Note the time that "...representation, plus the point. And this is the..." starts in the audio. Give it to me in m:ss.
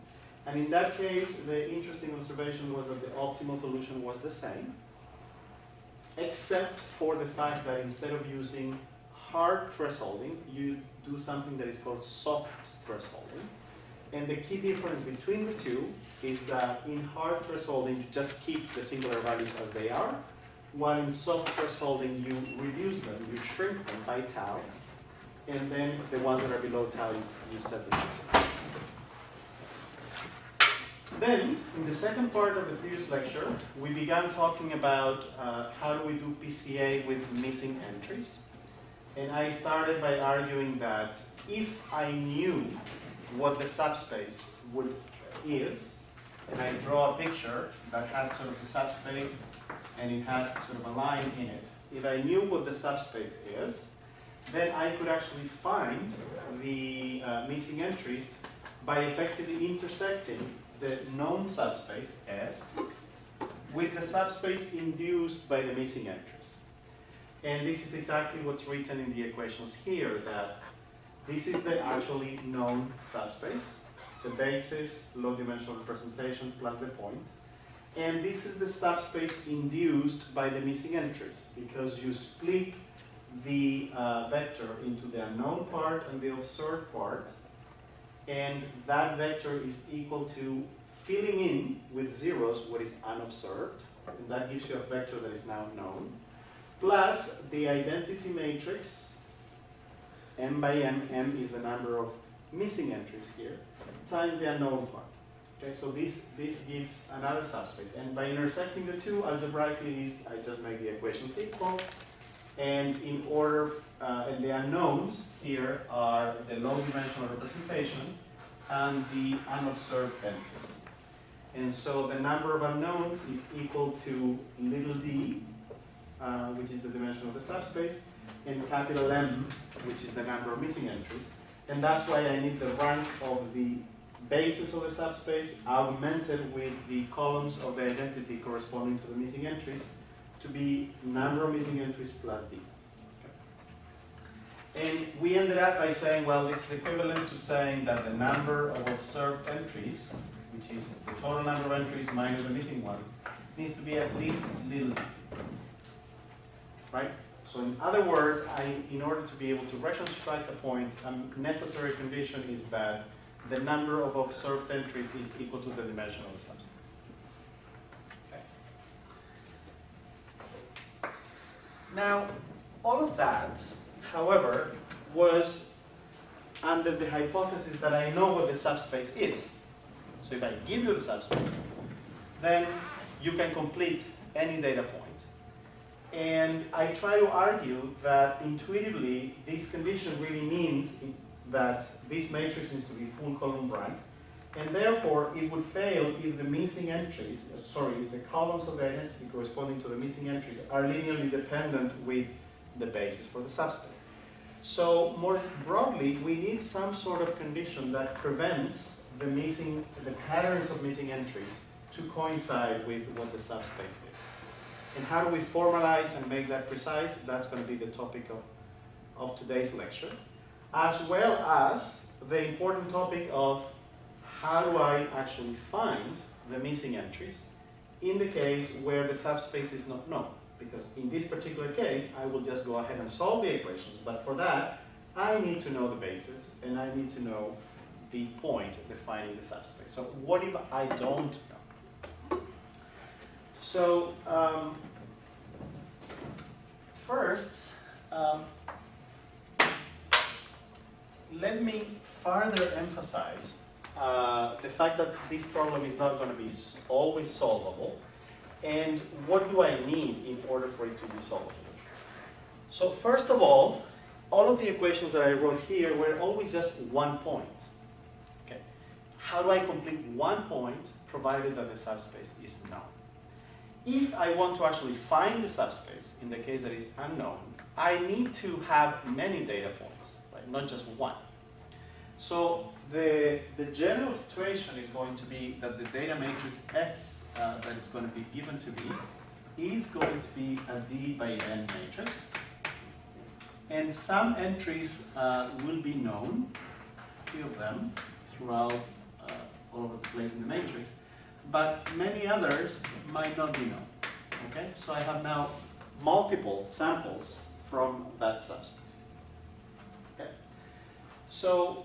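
1:15.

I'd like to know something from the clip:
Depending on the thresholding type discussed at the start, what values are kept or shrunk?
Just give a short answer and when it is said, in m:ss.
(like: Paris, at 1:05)
singular values, at 0:18.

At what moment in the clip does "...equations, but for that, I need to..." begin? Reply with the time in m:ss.
3:53.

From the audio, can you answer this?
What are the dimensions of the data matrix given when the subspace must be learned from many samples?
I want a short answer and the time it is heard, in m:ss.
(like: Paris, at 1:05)
D by N, at 4:50.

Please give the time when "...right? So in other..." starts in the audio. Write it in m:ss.
2:36.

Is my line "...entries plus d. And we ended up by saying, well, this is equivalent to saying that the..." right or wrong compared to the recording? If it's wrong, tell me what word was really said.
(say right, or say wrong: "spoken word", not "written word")
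right.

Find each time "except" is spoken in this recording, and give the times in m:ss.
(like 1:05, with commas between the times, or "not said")
0:06.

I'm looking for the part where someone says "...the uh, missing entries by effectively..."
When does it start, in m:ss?
0:56.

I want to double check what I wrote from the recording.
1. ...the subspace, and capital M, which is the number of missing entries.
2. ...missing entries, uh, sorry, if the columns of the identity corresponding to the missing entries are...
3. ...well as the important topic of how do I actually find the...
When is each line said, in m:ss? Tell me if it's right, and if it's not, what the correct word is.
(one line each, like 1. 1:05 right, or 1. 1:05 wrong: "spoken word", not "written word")
1. 2:07 right
2. 3:16 right
3. 3:41 right.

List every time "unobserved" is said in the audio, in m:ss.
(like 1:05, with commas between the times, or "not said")
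1:33, 1:59.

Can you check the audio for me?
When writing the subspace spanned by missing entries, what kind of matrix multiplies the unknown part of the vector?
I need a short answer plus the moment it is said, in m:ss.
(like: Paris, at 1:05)
identity matrix, at 1:37.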